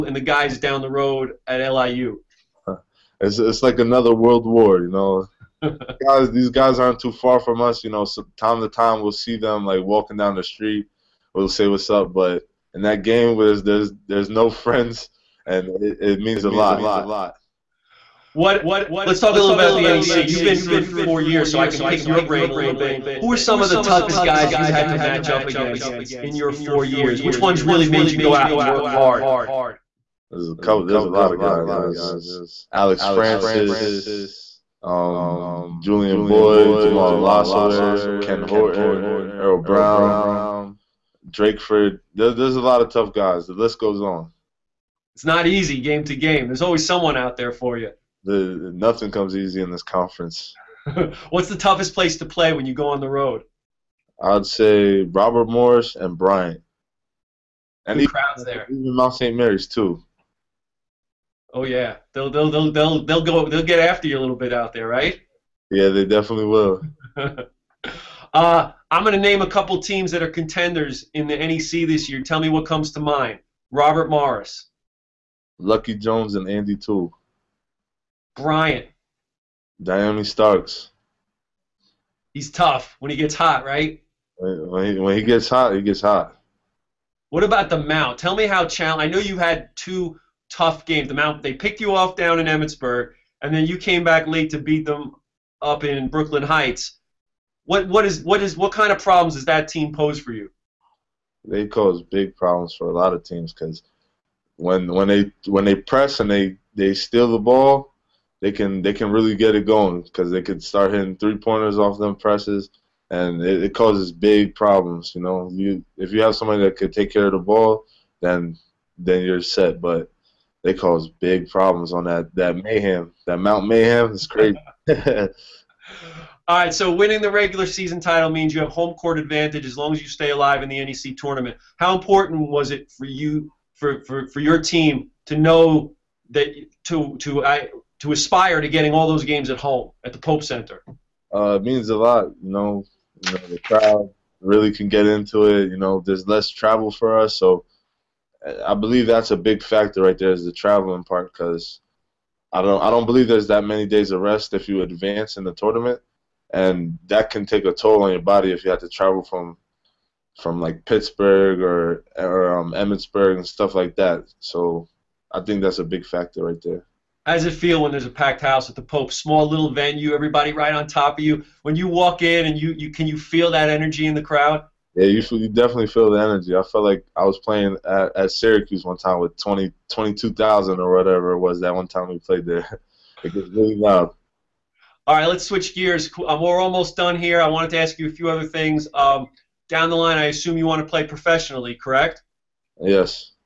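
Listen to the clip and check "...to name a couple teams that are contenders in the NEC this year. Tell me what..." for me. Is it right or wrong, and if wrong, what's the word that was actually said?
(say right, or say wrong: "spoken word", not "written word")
right.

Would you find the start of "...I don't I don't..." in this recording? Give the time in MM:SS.
02:32.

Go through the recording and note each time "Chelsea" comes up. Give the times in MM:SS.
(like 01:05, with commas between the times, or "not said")
not said.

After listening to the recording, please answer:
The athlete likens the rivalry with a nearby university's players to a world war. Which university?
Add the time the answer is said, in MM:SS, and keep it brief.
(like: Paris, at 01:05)
LIU, at 00:01.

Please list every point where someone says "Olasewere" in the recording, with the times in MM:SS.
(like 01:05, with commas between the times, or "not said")
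00:37.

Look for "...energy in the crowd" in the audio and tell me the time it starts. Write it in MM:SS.
02:53.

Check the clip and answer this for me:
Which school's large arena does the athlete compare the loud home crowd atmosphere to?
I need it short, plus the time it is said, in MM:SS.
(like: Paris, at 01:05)
Syracuse, at 02:58.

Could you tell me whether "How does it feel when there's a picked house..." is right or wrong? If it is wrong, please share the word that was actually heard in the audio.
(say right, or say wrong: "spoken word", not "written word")
wrong: "packed", not "picked".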